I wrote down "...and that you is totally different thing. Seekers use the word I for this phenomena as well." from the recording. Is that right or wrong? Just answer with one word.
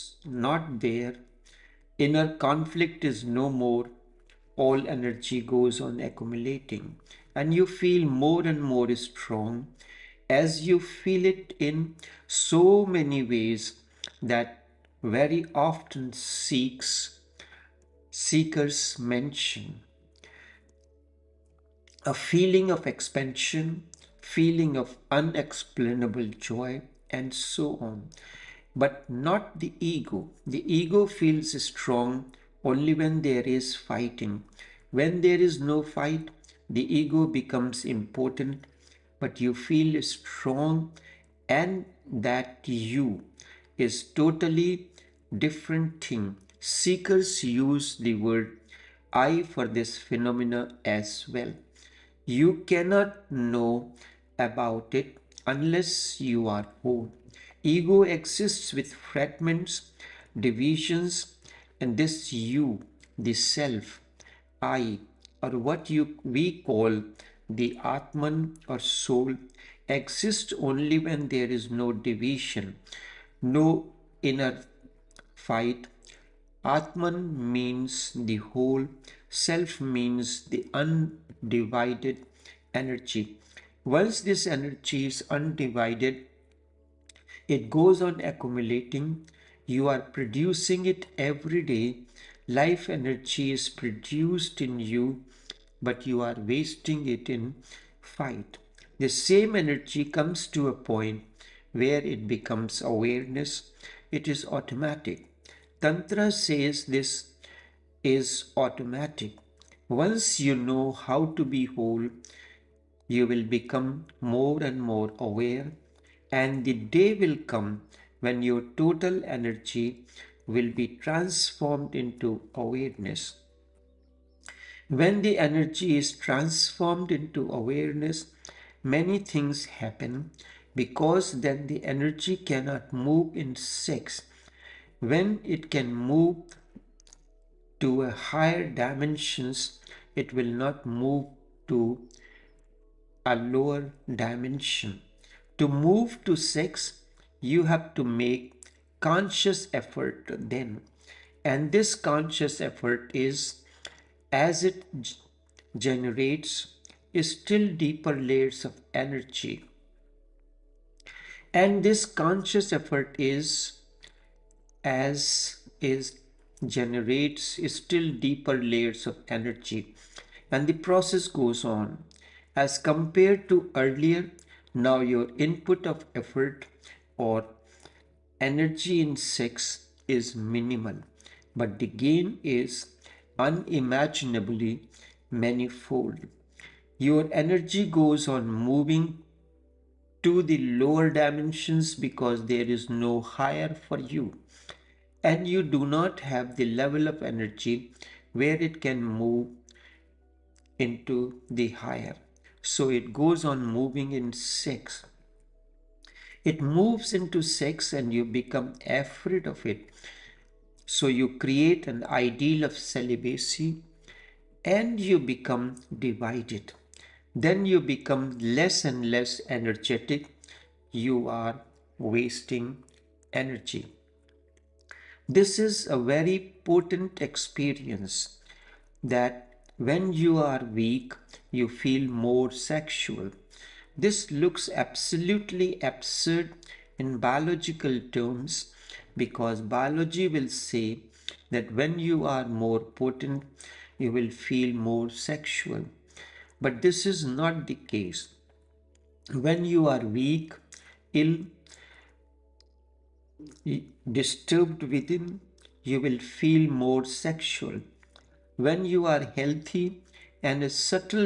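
right.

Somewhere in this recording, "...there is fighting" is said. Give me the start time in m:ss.
0:33.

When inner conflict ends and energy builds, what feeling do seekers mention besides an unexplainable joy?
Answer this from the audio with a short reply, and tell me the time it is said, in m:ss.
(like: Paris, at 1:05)
expansion, at 0:22.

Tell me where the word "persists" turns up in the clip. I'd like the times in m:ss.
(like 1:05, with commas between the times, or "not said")
not said.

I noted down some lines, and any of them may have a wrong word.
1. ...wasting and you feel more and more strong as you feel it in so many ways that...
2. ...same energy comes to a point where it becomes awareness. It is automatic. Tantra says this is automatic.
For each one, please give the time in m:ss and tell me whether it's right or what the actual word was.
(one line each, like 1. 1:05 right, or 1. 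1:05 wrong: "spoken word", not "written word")
1. 0:05 wrong: "accumulating", not "wasting"
2. 1:39 right.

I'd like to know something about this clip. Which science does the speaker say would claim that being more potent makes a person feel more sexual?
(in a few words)
biology.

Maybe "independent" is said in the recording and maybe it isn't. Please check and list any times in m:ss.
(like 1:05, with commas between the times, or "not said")
not said.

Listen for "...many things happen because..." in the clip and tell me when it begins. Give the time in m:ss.
2:08.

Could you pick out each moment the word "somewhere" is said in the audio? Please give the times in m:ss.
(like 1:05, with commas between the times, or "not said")
not said.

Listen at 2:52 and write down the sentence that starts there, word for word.
As compared to earlier, now your input of effort or energy in sex is minimal, but the gain is unimaginably manifold.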